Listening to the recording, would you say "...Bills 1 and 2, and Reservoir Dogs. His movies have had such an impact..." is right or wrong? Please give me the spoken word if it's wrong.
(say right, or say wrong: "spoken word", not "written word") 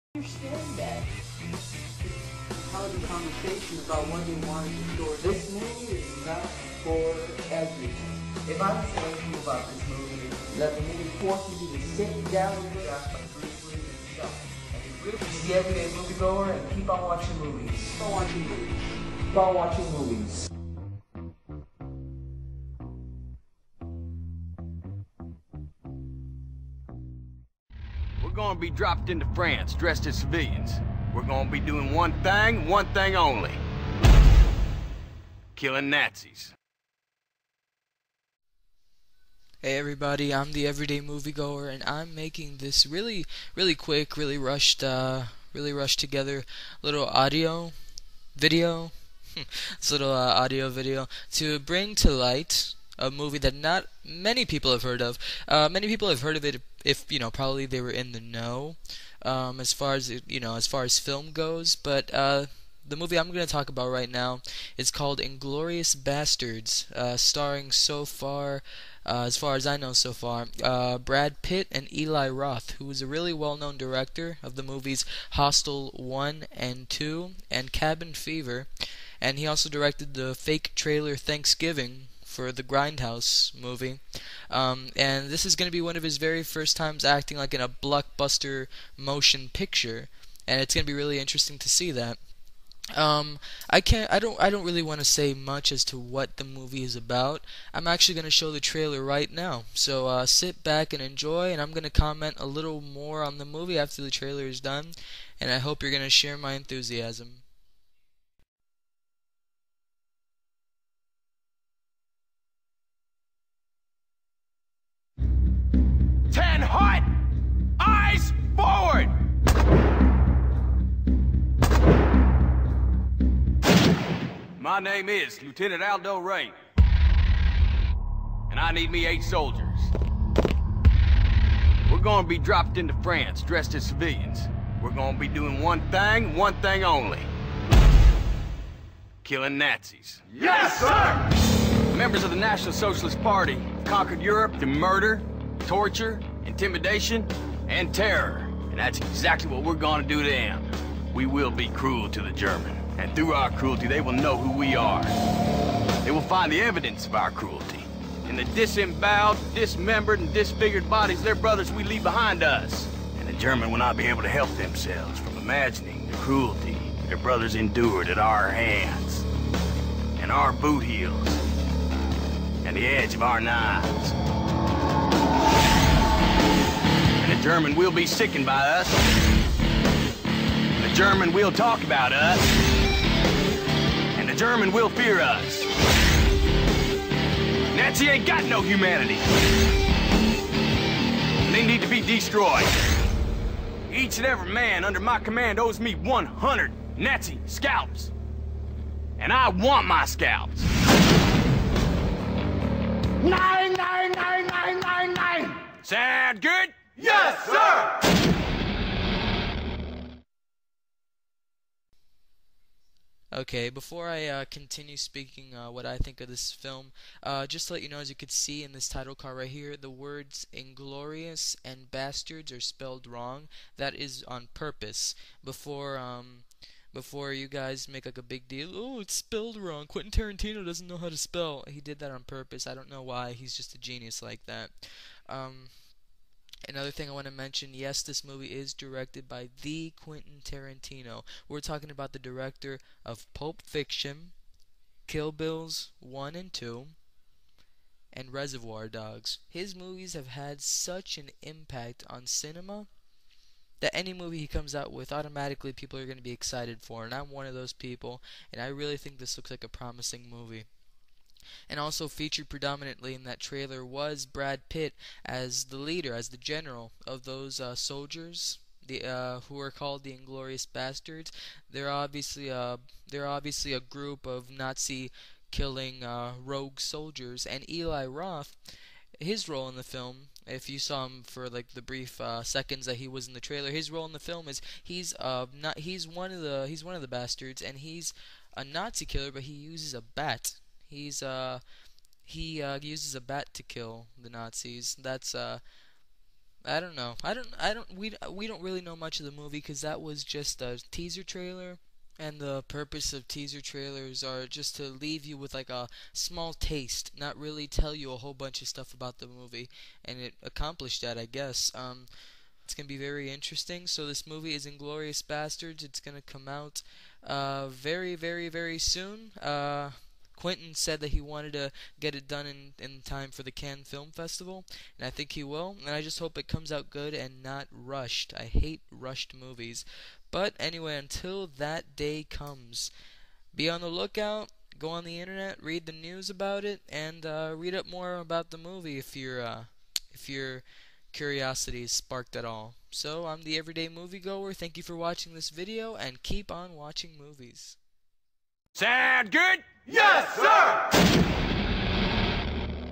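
right.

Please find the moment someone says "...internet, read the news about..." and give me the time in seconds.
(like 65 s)
335 s.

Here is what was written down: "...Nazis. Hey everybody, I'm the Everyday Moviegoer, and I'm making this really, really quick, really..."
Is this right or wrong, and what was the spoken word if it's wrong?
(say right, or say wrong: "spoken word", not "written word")
right.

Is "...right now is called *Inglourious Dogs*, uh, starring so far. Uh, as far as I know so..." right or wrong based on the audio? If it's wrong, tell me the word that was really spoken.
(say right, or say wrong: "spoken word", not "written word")
wrong: "Basterds", not "Dogs".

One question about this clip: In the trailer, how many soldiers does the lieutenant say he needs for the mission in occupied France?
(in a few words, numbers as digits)
8.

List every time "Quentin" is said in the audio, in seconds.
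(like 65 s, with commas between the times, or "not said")
229 s, 239 s, 320 s.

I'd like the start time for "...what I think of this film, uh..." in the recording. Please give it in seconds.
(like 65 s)
215 s.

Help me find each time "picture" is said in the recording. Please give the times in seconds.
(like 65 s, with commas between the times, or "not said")
89 s.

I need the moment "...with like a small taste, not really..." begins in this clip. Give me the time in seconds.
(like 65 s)
305 s.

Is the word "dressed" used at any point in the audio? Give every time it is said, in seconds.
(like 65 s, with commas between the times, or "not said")
29 s, 133 s.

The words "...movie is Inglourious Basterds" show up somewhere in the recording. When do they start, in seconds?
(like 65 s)
314 s.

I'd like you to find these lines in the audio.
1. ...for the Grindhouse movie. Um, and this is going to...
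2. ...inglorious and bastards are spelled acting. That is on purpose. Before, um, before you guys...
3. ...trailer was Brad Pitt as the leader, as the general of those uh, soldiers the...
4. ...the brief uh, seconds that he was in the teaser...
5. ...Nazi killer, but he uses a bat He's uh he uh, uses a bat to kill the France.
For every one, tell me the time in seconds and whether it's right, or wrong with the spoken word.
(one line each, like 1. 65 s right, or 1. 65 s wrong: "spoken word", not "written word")
1. 82 s right
2. 220 s wrong: "wrong", not "acting"
3. 263 s right
4. 281 s wrong: "trailer", not "teaser"
5. 288 s wrong: "Nazis", not "France".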